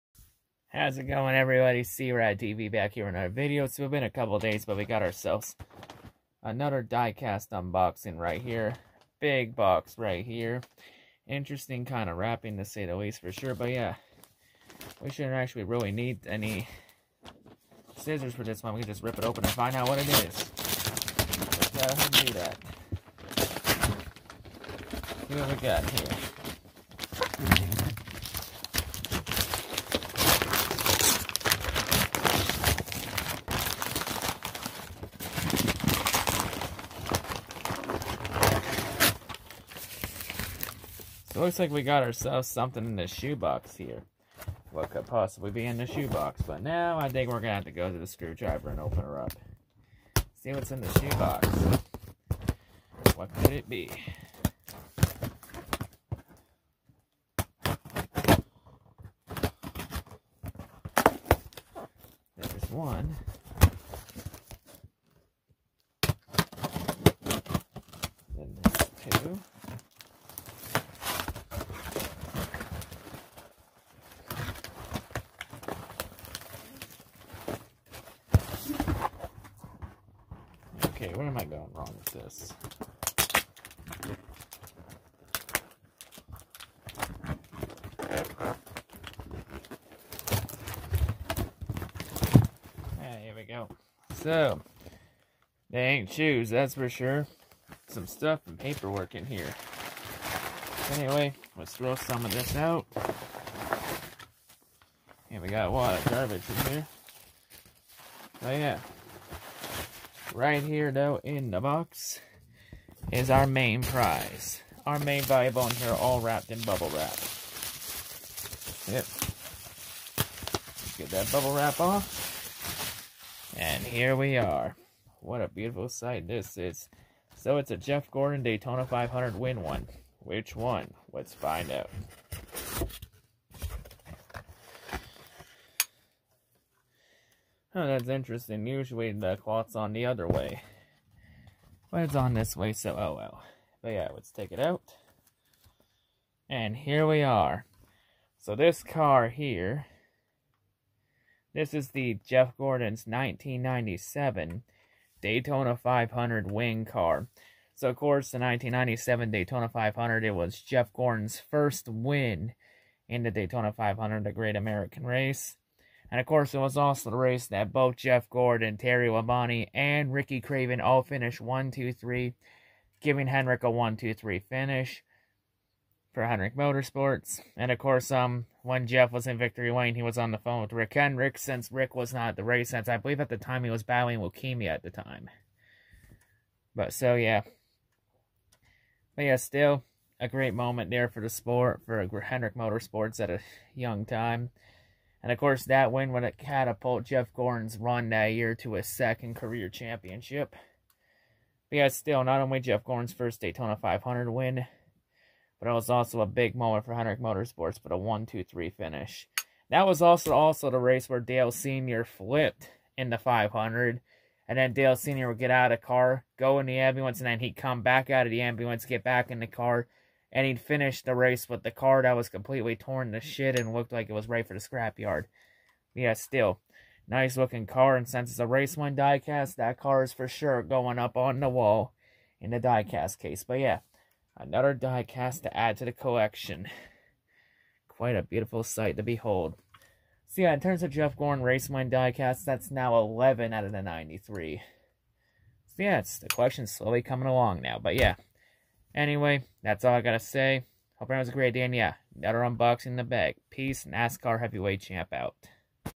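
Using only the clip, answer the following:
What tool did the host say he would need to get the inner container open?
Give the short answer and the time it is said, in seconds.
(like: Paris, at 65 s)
screwdriver, at 48 s.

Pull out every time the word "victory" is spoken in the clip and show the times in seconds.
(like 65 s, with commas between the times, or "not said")
179 s.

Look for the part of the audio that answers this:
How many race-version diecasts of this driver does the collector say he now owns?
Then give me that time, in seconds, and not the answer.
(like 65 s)
242 s.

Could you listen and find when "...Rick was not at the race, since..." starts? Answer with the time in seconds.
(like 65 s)
181 s.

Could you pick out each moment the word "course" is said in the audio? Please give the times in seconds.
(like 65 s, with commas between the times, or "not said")
157 s, 166 s, 177 s, 195 s.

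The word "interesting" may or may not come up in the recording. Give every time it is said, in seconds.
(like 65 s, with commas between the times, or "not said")
11 s, 138 s.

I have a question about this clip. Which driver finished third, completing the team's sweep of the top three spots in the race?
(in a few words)
Ricky Craven.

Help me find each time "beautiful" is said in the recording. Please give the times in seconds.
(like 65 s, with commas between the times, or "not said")
125 s, 238 s.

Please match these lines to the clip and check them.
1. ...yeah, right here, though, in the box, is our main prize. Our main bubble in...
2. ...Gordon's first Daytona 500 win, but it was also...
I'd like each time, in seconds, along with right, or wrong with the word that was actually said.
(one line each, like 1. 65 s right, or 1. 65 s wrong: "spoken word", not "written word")
1. 108 s wrong: "valuable", not "bubble"
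2. 202 s right.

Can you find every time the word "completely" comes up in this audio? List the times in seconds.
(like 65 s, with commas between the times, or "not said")
222 s.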